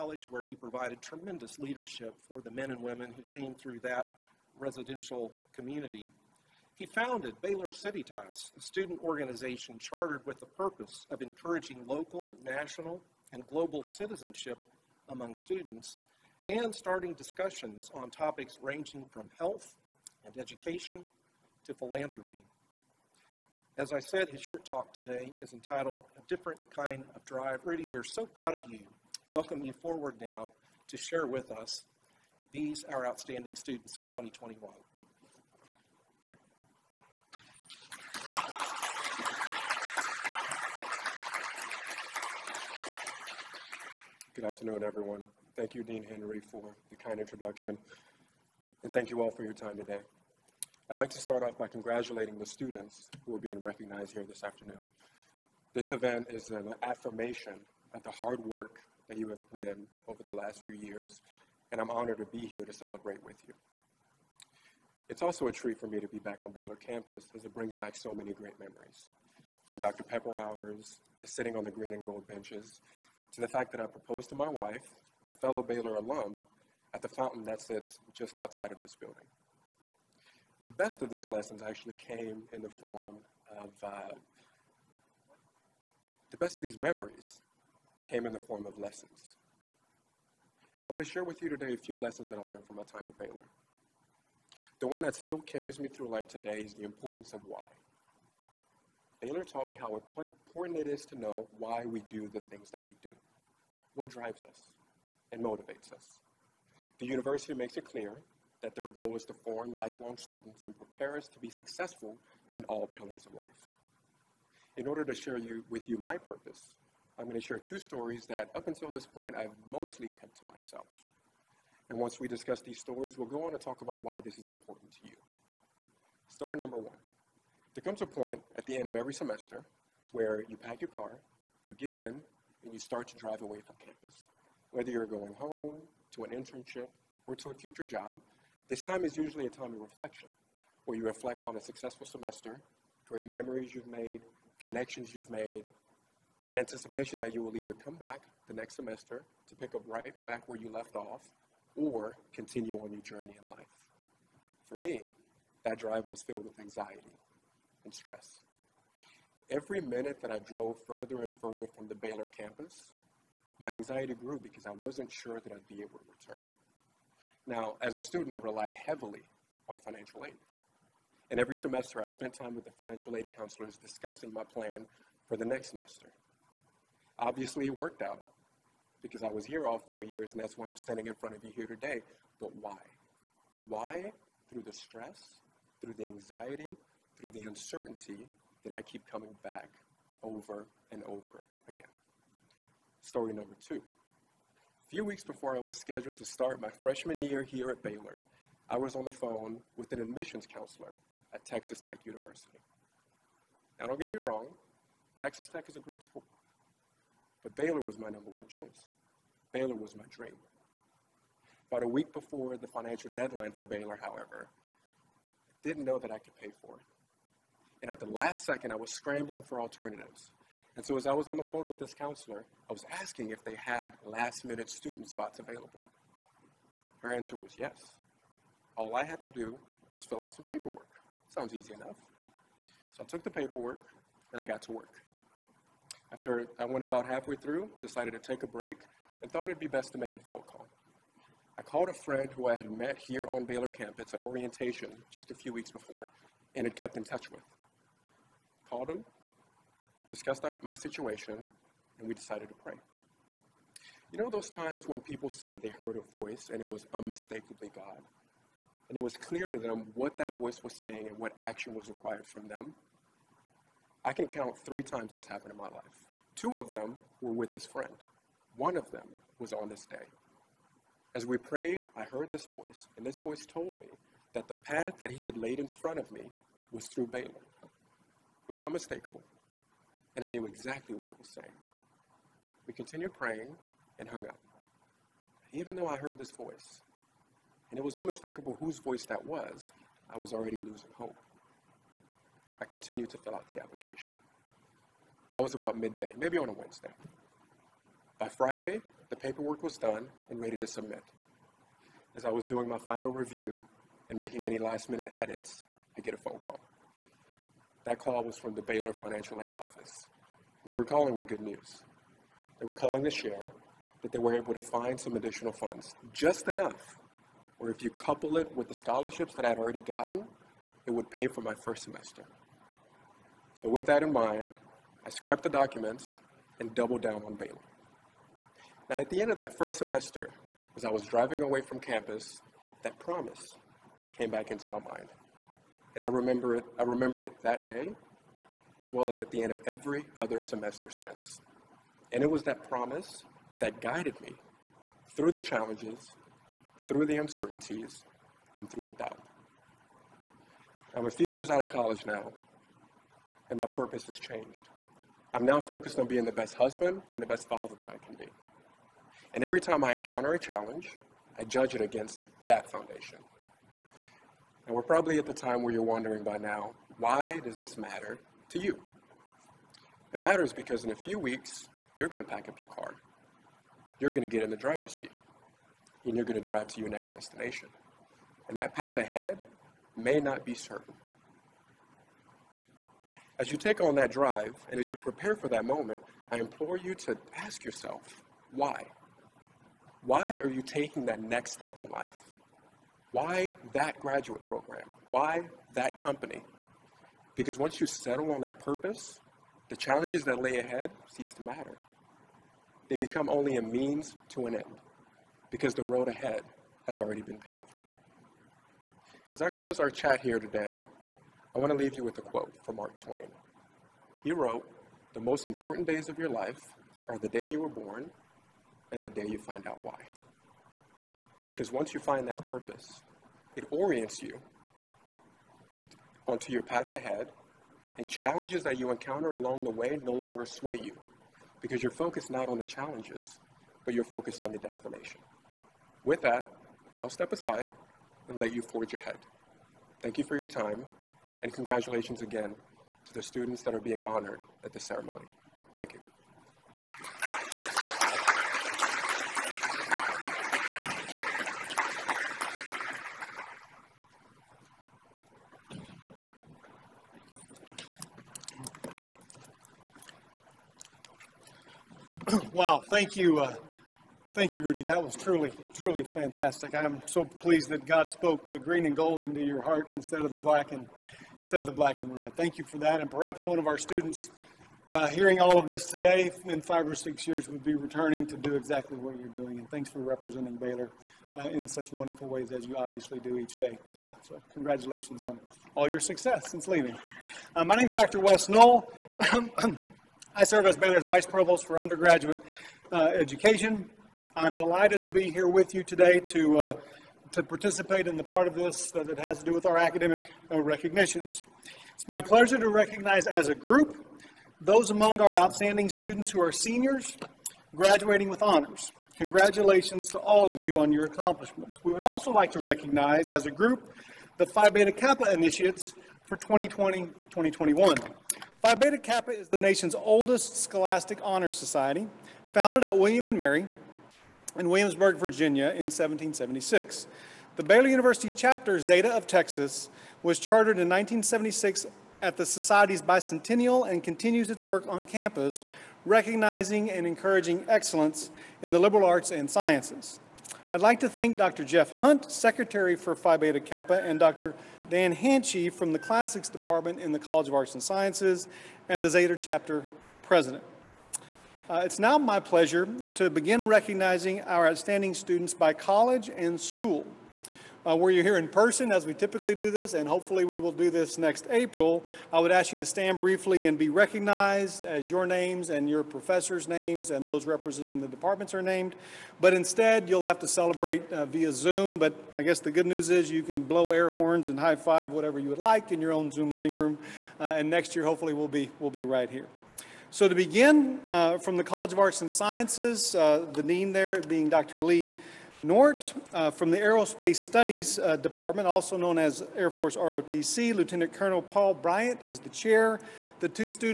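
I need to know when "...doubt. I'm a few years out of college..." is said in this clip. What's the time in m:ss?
5:48.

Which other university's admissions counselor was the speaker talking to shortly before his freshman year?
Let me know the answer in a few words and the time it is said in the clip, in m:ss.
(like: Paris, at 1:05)
Texas Tech University, at 3:21.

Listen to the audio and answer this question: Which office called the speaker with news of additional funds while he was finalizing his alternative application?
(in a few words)
Baylor Financial Aid Office.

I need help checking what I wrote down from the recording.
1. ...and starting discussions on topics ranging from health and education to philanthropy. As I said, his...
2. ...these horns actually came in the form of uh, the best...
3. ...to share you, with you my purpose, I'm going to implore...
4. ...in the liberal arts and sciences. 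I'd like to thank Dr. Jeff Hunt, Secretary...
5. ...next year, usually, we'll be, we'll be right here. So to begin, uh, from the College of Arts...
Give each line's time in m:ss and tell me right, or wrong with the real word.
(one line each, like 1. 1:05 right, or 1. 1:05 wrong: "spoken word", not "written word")
1. 0:16 right
2. 1:21 wrong: "lessons", not "horns"
3. 1:55 wrong: "share", not "implore"
4. 8:58 right
5. 9:37 wrong: "hopefully", not "usually".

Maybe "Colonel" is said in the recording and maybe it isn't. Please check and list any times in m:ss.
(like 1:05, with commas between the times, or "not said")
9:51.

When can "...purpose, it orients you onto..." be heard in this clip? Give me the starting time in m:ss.
7:02.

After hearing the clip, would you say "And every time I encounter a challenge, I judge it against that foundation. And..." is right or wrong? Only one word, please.
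right.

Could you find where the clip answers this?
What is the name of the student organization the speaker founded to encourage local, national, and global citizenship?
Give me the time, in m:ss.
0:07.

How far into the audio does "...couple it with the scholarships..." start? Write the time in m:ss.
5:17.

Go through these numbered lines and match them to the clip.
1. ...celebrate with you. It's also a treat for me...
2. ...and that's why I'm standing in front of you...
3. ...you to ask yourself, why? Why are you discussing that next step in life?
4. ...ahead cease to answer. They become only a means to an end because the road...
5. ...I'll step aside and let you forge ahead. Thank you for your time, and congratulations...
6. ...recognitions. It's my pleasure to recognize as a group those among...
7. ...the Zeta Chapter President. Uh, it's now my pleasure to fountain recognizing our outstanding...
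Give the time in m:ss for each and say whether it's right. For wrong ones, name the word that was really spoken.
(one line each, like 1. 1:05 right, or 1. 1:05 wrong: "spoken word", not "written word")
1. 1:02 right
2. 3:00 right
3. 6:26 wrong: "taking", not "discussing"
4. 6:40 wrong: "matter", not "answer"
5. 7:17 right
6. 8:20 right
7. 9:09 wrong: "begin", not "fountain".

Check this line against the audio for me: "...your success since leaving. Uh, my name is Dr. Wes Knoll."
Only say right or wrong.
right.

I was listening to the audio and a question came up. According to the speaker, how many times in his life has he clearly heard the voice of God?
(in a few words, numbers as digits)
3.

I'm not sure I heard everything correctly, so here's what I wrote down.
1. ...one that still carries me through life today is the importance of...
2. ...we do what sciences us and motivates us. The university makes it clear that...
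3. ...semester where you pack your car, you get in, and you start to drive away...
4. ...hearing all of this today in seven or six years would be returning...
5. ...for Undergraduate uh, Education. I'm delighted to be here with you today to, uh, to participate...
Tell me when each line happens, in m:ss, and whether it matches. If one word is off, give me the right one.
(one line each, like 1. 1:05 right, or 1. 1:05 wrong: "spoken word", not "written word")
1. 1:34 right
2. 1:42 wrong: "drives", not "sciences"
3. 2:09 right
4. 7:55 wrong: "five", not "seven"
5. 8:11 right.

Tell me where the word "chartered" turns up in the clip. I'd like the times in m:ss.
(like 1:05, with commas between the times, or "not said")
0:09, 8:50.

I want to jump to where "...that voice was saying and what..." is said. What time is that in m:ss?
4:20.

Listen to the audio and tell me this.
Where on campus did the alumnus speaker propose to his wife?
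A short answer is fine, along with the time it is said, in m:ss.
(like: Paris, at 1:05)
At the fountain, at 1:17.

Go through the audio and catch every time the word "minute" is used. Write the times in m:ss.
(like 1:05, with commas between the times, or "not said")
2:39, 3:44, 5:04.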